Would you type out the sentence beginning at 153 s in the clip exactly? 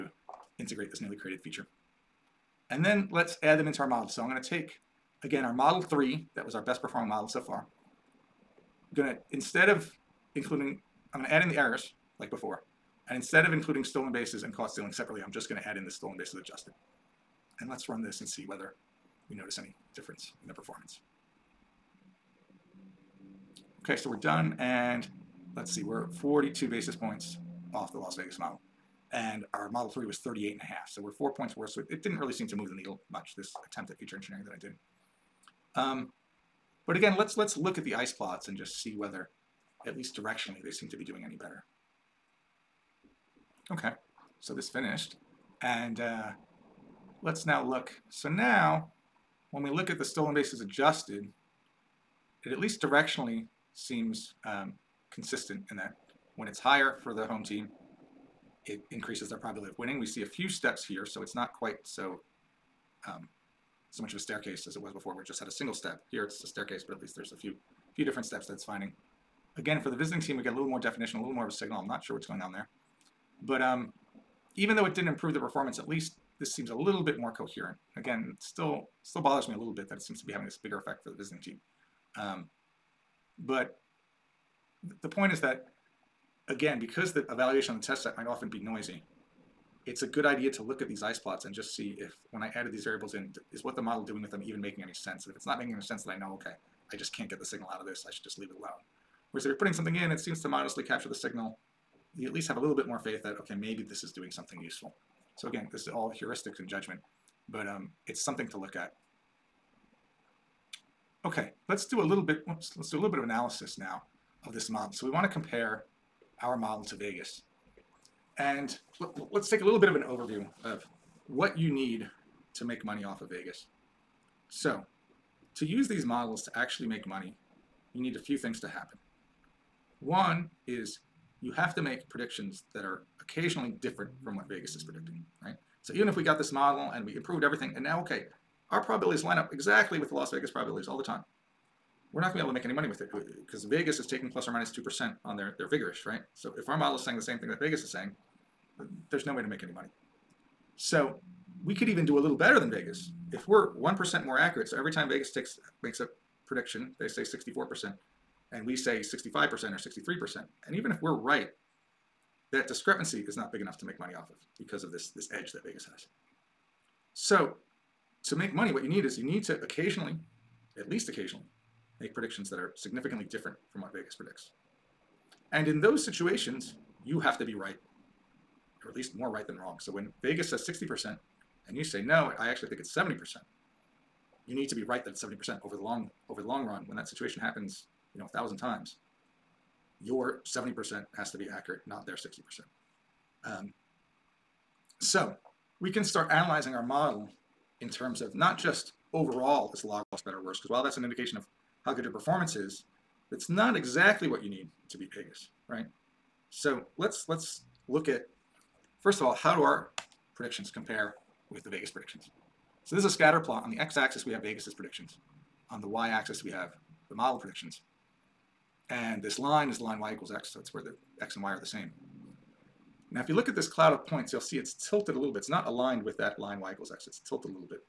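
If we're 1% more accurate, so every time Vegas takes makes a prediction, they say 64%, and we say 65% or 63%.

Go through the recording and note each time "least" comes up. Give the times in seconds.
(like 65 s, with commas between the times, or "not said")
39 s, 52 s, 66 s, 75 s, 102 s, 170 s, 178 s.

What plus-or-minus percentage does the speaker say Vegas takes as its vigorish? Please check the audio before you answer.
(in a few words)
2%.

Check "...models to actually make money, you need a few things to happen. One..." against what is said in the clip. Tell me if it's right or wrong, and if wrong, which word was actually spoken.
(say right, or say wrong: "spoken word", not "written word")
right.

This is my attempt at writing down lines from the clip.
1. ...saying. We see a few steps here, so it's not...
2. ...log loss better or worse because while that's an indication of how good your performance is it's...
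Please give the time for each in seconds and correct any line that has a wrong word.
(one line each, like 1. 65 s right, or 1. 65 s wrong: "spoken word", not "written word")
1. 59 s wrong: "winning", not "saying"
2. 199 s right.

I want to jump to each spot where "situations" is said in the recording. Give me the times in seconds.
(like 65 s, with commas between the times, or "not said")
176 s, 187 s.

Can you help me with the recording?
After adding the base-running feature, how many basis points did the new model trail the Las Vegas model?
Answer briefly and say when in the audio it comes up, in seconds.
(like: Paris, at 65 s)
42, at 26 s.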